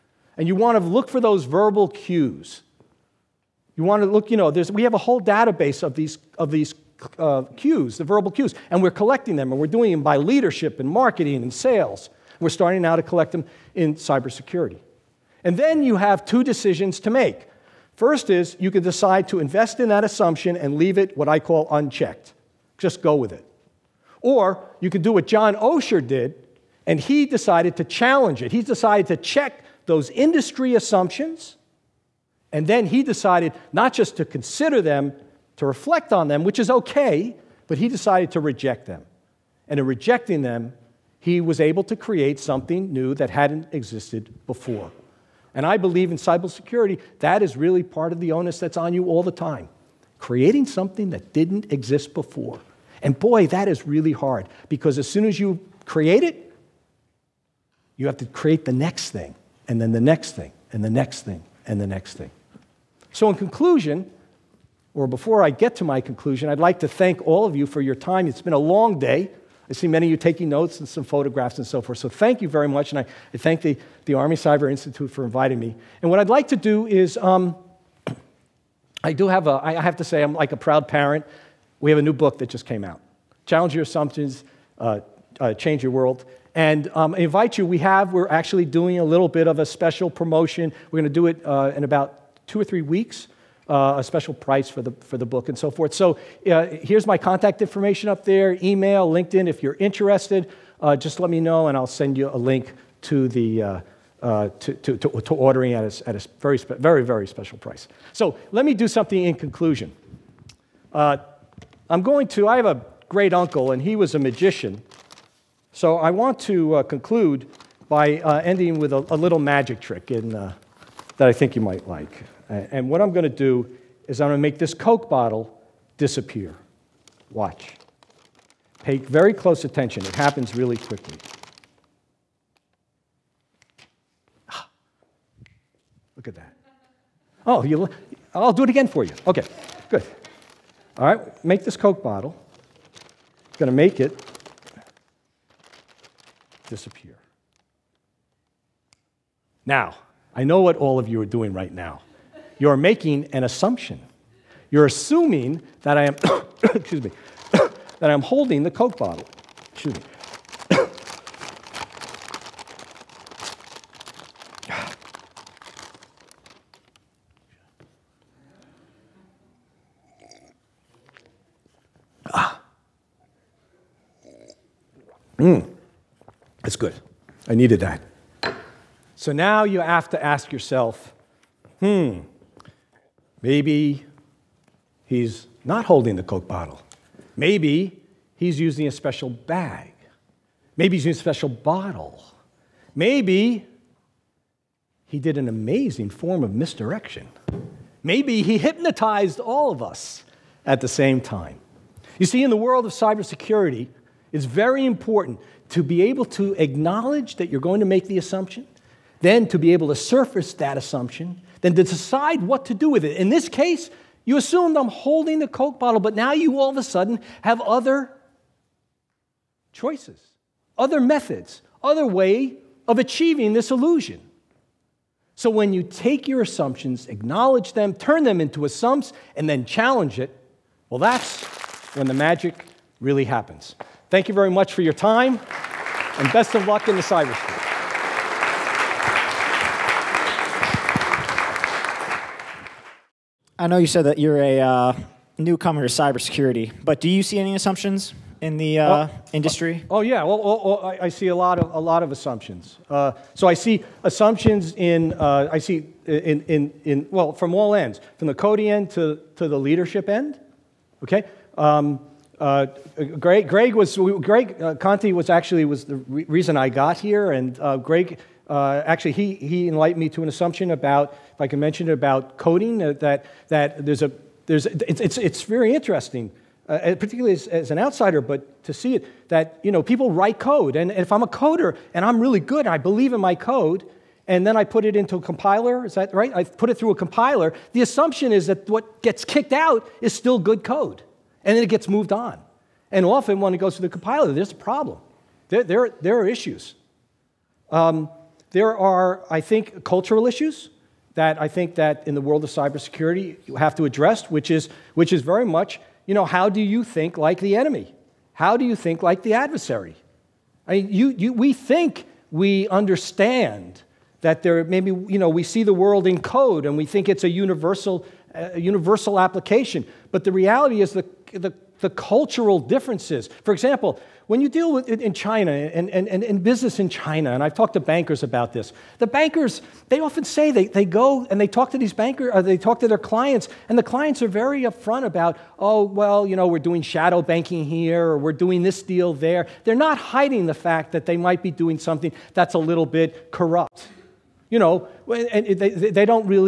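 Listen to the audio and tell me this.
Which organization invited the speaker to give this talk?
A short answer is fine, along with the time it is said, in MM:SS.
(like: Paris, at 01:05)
Army Cyber Institute, at 01:14.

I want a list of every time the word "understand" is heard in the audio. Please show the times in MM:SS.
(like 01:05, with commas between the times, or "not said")
05:12.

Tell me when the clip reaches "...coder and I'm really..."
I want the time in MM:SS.
04:41.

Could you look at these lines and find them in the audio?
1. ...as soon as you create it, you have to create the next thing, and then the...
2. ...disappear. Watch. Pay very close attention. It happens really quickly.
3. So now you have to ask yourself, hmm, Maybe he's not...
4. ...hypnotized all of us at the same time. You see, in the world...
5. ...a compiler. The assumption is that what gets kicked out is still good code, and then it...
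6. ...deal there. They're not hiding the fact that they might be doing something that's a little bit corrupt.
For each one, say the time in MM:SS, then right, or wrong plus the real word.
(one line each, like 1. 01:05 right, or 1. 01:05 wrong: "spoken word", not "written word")
1. 00:54 right
2. 02:05 right
3. 02:59 right
4. 03:18 right
5. 04:46 right
6. 05:38 right.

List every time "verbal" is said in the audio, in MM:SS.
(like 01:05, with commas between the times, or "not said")
00:01, 00:08.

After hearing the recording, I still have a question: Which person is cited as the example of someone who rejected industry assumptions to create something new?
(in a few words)
John Osher.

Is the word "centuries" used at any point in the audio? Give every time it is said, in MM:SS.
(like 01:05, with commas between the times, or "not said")
not said.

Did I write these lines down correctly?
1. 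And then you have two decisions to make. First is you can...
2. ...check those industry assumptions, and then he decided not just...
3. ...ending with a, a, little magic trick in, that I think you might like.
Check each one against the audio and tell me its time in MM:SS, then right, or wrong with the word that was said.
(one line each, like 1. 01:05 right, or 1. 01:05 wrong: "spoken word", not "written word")
1. 00:15 right
2. 00:29 right
3. 01:58 right.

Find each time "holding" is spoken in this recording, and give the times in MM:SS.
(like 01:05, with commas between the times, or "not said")
02:38, 03:05, 03:34.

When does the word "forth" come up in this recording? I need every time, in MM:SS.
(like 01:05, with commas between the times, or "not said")
01:11, 01:35.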